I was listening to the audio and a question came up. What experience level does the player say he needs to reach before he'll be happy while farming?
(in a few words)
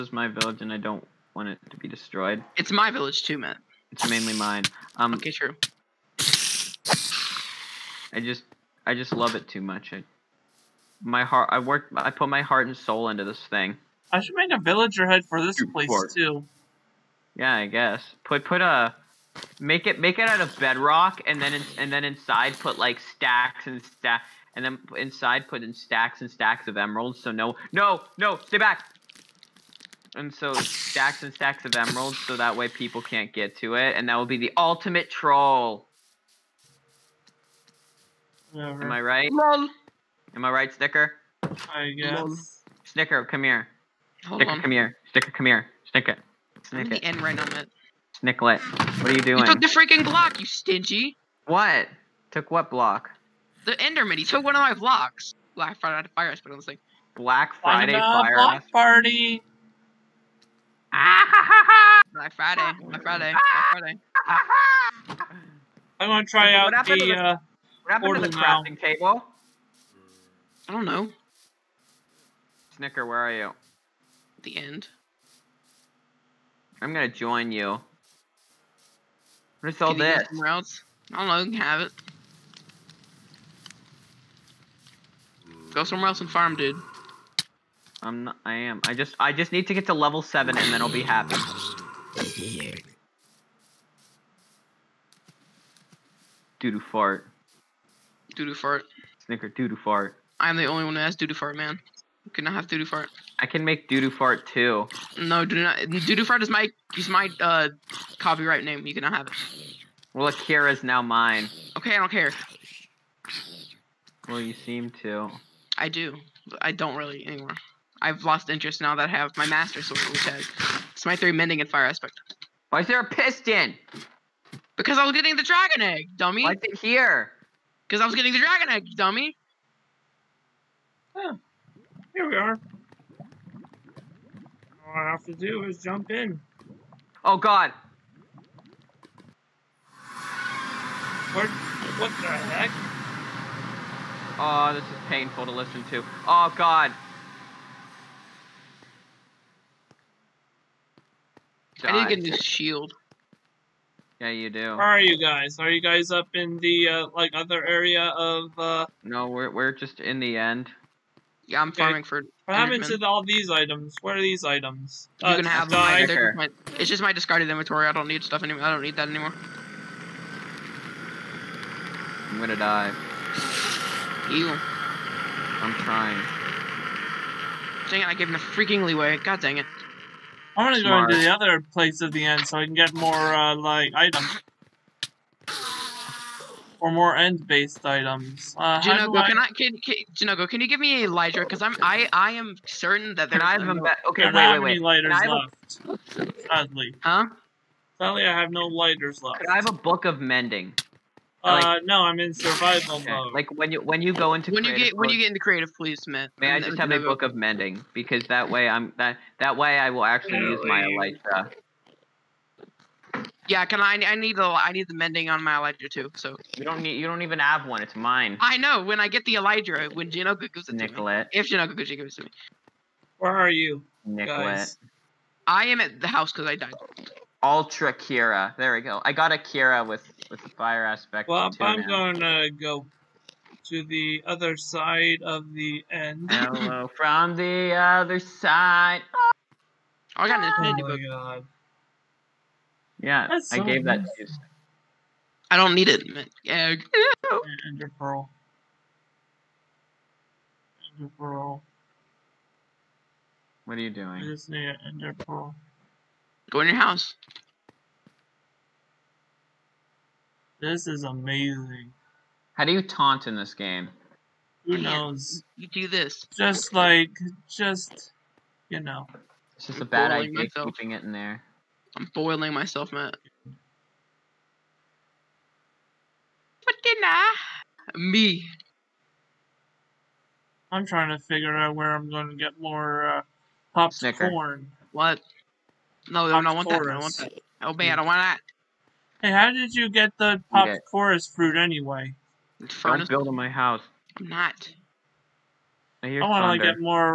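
7.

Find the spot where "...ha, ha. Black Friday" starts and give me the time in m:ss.
1:01.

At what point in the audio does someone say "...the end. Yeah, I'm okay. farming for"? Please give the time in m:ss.
2:40.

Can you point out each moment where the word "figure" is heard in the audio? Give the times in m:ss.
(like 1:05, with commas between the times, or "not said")
4:41.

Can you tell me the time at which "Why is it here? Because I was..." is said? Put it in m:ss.
2:06.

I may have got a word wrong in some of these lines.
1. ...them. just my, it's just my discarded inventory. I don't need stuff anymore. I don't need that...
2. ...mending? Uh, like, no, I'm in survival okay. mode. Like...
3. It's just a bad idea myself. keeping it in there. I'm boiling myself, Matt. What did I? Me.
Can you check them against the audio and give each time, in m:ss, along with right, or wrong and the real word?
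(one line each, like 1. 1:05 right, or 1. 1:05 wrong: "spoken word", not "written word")
1. 2:45 right
2. 3:20 right
3. 4:29 right.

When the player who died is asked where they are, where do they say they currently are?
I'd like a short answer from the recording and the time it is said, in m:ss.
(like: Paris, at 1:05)
at the house, at 3:45.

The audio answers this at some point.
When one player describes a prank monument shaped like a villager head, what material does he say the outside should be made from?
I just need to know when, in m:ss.
0:20.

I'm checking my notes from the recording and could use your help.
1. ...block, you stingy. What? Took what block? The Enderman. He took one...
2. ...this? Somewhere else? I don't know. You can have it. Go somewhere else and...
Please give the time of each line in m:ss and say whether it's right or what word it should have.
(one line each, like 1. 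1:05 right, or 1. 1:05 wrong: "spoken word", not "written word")
1. 0:50 right
2. 1:19 right.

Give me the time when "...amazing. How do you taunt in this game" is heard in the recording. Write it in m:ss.
4:21.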